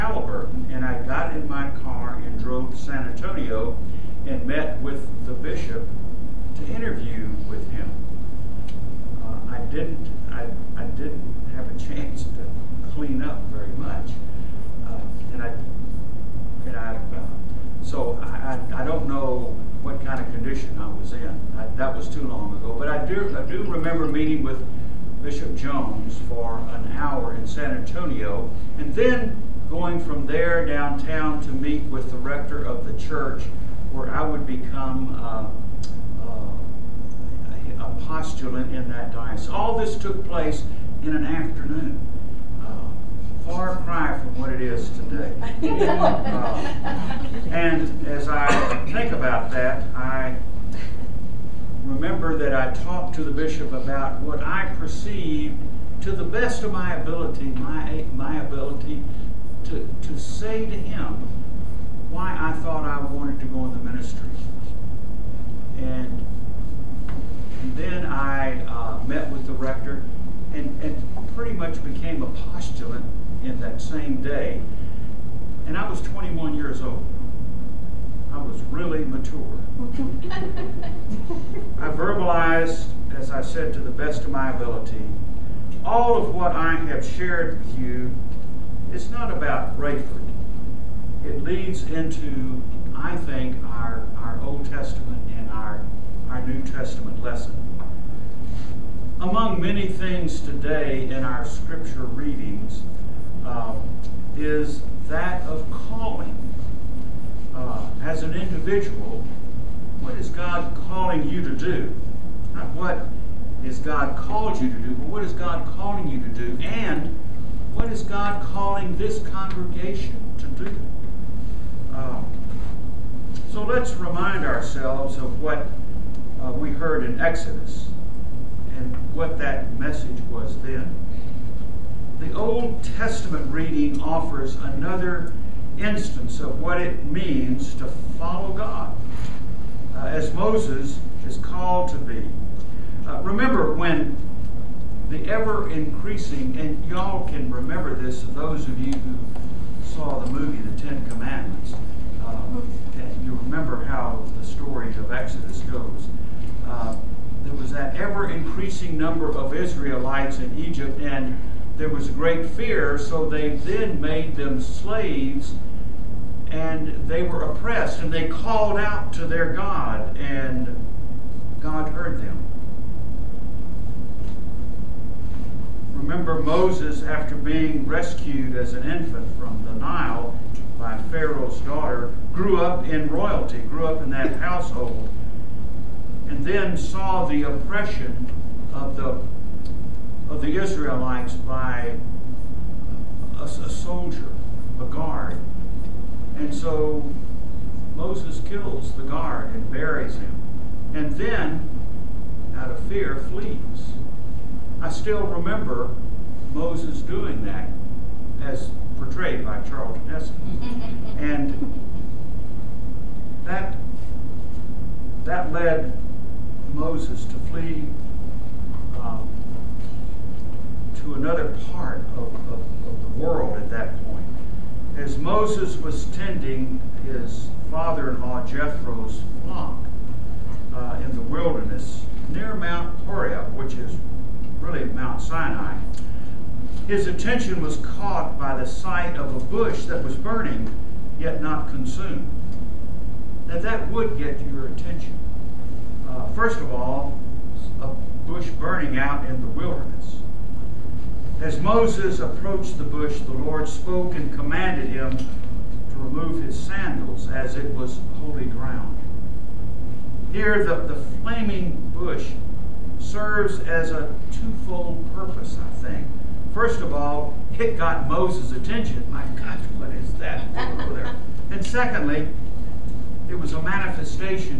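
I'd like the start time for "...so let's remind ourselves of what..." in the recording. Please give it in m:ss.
2:03.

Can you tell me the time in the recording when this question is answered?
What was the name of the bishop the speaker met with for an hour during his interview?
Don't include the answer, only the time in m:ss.
0:25.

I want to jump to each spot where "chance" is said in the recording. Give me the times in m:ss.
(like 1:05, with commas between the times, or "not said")
0:11.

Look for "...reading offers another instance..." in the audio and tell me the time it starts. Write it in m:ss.
2:13.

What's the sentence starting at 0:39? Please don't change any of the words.
All this took place in an afternoon far cry from what it is today.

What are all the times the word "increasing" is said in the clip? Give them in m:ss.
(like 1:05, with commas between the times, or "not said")
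2:25, 2:38.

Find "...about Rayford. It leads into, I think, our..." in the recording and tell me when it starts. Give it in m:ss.
1:29.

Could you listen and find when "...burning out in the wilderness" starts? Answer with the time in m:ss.
4:08.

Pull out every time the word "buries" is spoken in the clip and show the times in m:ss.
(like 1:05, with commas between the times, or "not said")
3:19.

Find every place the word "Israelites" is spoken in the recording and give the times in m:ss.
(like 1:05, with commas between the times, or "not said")
2:39, 3:10.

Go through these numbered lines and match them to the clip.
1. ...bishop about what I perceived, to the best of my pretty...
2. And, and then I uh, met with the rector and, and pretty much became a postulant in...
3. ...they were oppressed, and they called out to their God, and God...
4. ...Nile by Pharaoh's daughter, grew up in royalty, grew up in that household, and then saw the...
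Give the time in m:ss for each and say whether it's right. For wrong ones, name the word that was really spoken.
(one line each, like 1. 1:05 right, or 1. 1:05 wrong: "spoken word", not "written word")
1. 0:53 wrong: "ability", not "pretty"
2. 1:05 right
3. 2:47 right
4. 2:59 right.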